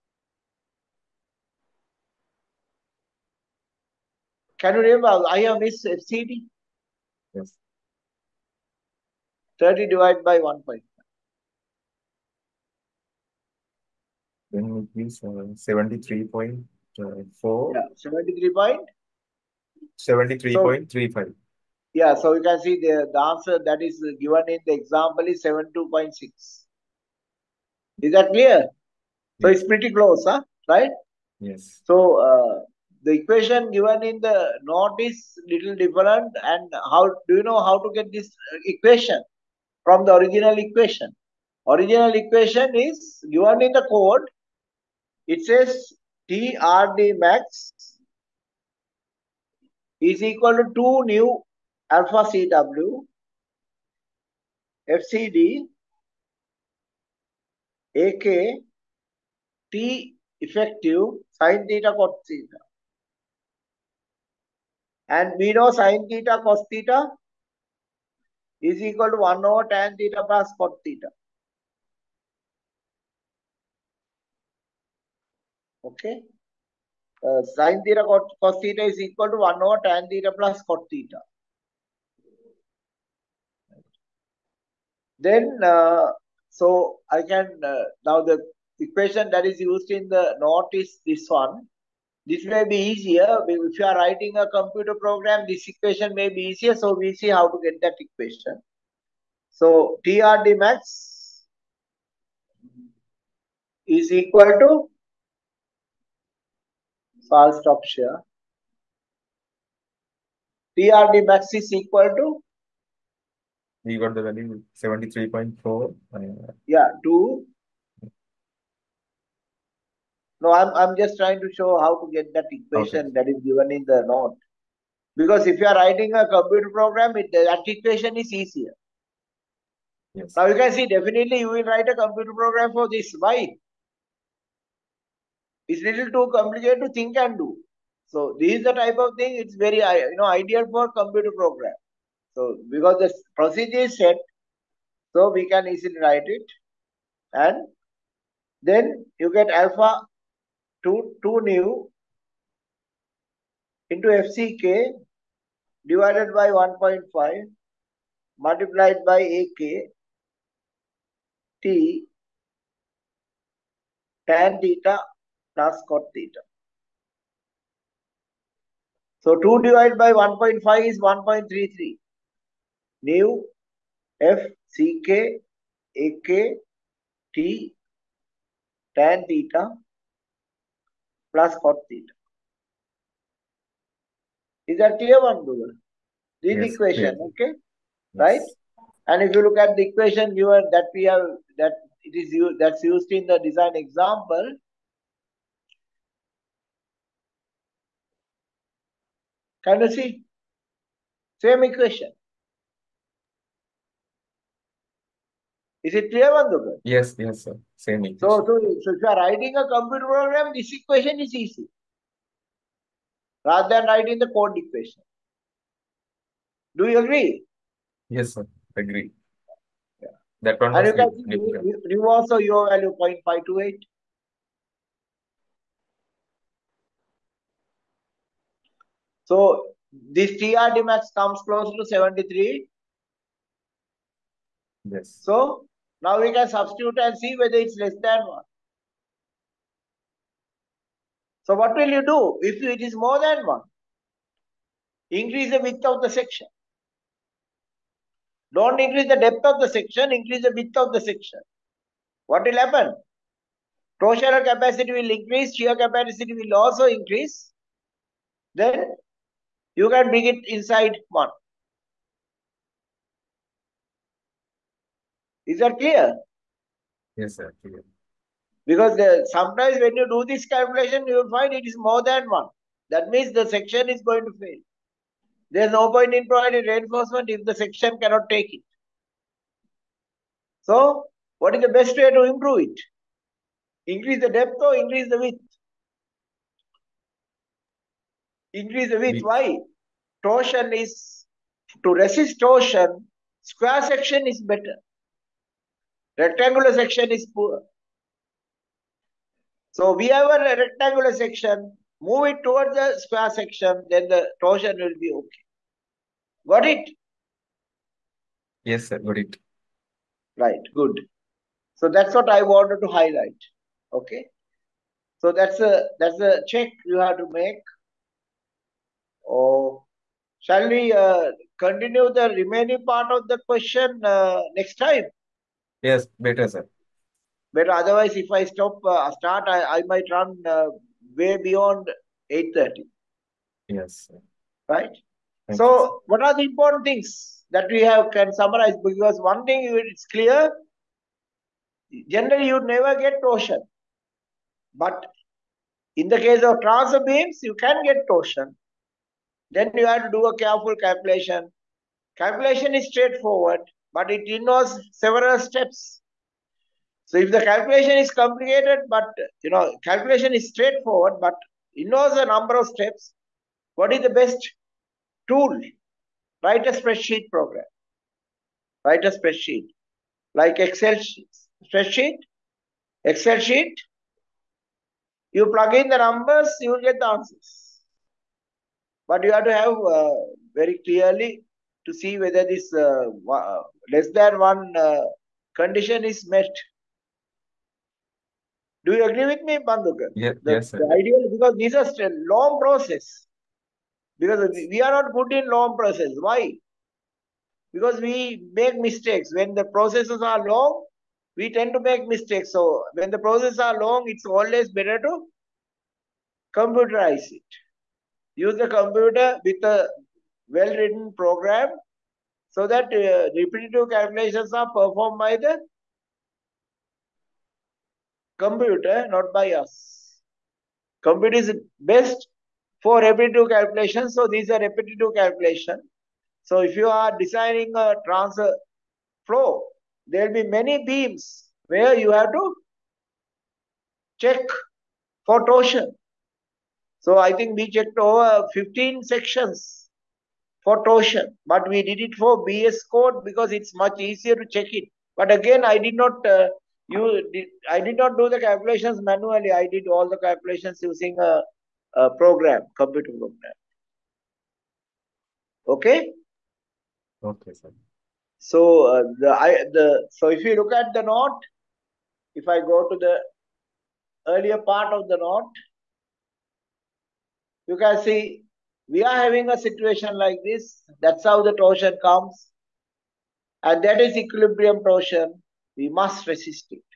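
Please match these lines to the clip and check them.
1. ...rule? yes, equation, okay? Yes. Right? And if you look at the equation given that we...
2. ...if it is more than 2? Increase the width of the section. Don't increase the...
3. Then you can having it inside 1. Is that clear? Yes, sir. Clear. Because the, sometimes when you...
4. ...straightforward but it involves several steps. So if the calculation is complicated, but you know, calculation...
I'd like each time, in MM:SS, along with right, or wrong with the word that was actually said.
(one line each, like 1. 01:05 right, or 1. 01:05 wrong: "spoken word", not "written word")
1. 03:05 right
2. 04:02 wrong: "1", not "2"
3. 04:18 wrong: "bring", not "having"
4. 05:52 right.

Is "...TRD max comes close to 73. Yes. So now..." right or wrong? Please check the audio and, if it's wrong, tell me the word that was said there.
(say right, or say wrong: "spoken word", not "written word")
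right.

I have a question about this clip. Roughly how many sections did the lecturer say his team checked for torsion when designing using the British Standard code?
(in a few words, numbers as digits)
over 15.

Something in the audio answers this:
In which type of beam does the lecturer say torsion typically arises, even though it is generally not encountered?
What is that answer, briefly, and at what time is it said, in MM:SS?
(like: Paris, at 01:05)
transfer beams, at 05:46.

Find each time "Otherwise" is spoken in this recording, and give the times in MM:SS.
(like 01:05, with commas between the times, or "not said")
05:27.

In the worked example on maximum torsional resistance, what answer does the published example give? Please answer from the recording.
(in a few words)
72.6.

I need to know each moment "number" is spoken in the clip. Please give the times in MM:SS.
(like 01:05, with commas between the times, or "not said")
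06:02, 06:15.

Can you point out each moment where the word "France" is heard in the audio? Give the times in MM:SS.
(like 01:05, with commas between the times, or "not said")
not said.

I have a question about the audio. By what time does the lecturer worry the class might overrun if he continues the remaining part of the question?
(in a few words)
8:30.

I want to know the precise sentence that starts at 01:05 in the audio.
And we know sine theta cos theta is equal to 1 over tan theta plus cot theta.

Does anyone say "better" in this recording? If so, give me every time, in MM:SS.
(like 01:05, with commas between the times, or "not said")
04:54, 05:26, 06:44.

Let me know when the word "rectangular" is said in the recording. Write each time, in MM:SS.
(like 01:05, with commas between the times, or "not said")
04:56, 05:00.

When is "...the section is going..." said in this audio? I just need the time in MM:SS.
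04:33.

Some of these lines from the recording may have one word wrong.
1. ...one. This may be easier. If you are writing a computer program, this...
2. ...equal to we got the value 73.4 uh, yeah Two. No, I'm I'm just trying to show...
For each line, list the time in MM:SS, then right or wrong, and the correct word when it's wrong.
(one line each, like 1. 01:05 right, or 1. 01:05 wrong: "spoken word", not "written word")
1. 01:31 right
2. 01:51 right.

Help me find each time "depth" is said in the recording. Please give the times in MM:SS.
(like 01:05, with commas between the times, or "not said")
04:09, 04:44.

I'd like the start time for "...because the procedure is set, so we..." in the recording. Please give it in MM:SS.
02:22.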